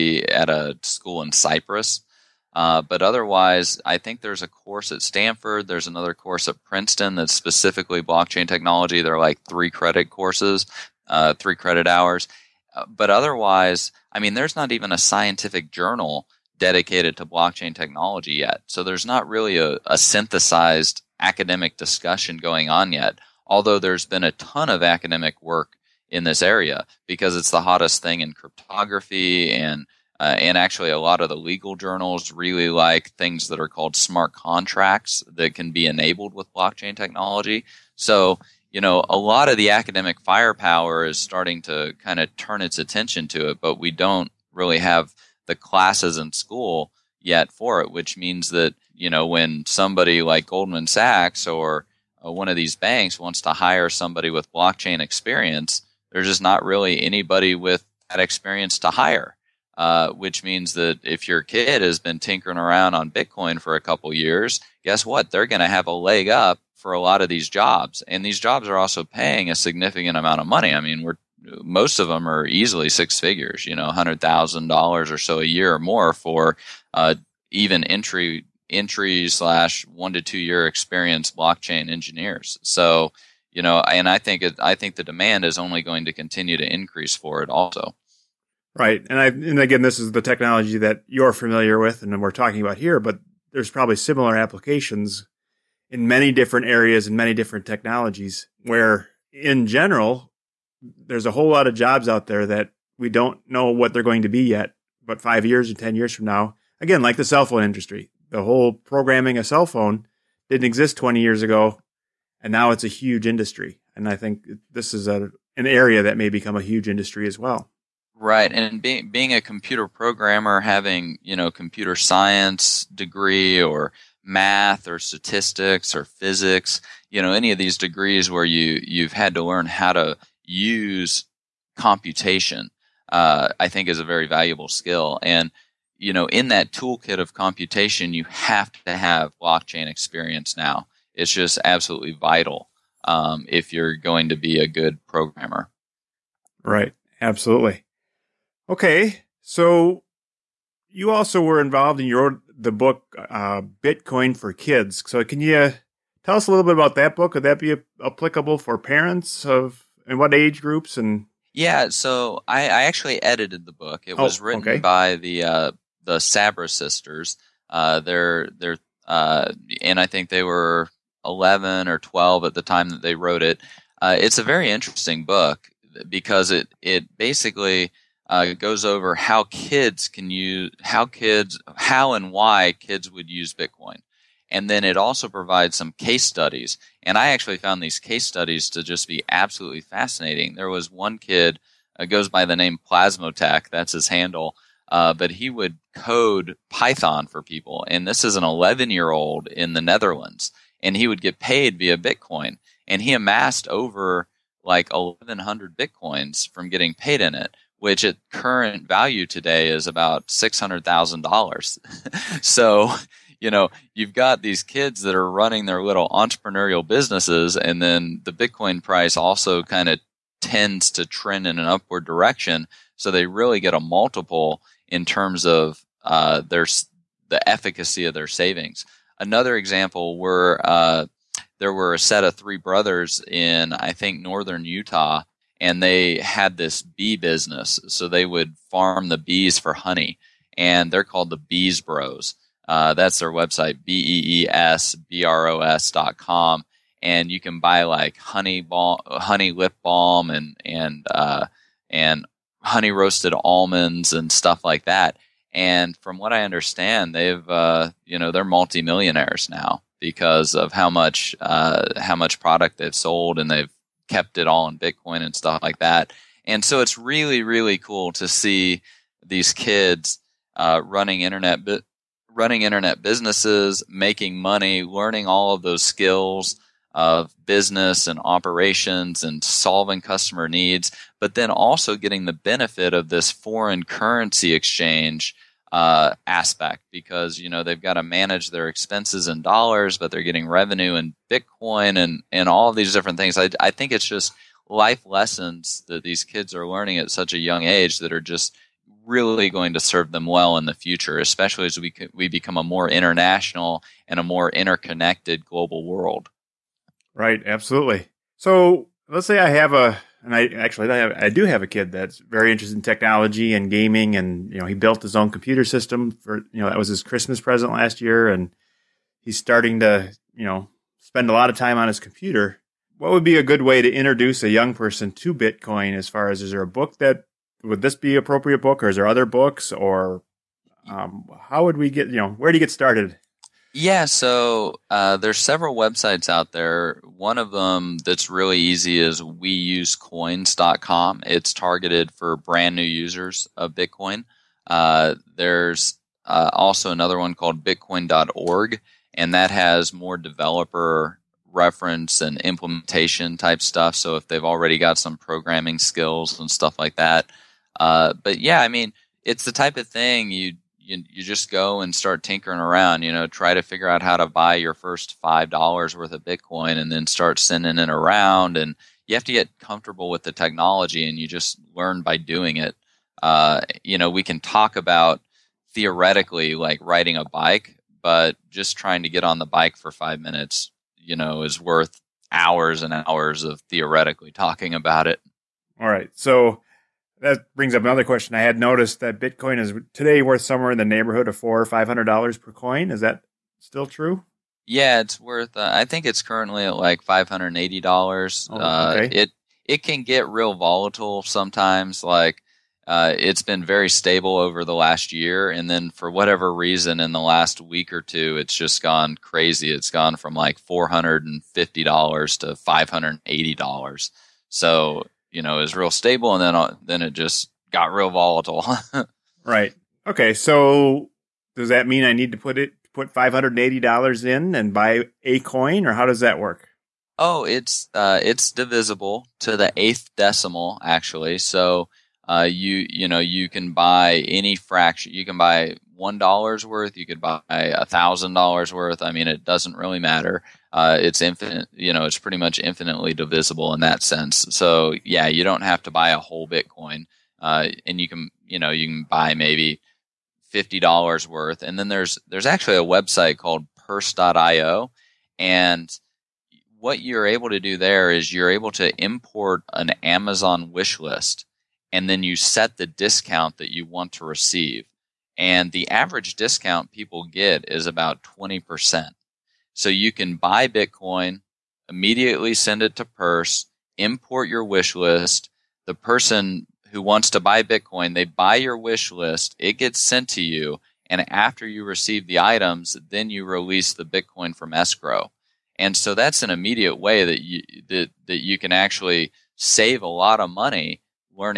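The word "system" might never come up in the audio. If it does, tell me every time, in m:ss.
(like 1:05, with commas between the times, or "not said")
5:15.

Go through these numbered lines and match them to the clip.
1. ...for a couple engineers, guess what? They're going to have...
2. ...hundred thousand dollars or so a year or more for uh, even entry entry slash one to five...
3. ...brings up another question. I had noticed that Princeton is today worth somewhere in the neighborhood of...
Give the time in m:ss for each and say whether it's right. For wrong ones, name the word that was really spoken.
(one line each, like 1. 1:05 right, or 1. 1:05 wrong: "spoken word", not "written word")
1. 1:03 wrong: "years", not "engineers"
2. 1:13 wrong: "two", not "five"
3. 6:27 wrong: "Bitcoin", not "Princeton".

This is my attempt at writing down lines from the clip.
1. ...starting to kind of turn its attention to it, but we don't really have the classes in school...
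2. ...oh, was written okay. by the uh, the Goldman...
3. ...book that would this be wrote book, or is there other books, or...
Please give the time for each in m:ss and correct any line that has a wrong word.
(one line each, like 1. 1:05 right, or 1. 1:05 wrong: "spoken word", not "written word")
1. 0:41 right
2. 2:44 wrong: "Sabra", not "Goldman"
3. 5:26 wrong: "appropriate", not "wrote".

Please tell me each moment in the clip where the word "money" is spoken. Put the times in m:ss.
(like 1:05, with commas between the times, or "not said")
1:10, 4:34, 8:10.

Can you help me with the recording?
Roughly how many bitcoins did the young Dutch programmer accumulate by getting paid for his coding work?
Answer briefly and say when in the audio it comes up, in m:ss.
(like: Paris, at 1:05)
1100, at 3:24.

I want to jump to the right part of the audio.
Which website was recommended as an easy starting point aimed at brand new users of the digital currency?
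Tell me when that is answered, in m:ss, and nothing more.
5:39.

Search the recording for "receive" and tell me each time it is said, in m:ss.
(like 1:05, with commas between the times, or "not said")
7:44, 8:01.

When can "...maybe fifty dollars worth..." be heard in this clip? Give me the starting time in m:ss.
7:29.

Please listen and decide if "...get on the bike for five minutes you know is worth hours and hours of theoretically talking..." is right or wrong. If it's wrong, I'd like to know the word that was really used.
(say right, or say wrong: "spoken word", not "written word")
right.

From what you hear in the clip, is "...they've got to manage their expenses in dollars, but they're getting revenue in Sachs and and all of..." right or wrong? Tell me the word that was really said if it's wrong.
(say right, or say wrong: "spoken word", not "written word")
wrong: "Bitcoin", not "Sachs".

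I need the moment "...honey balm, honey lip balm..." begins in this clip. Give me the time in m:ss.
4:08.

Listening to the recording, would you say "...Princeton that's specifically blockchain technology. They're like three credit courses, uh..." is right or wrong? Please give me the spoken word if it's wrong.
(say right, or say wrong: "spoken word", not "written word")
right.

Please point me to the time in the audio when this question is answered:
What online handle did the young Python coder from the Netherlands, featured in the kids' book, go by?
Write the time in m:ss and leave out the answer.
3:12.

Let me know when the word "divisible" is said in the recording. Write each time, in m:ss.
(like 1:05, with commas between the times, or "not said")
7:08, 7:23.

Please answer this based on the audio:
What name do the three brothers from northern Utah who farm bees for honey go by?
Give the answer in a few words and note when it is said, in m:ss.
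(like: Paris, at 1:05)
Bees Bros, at 4:01.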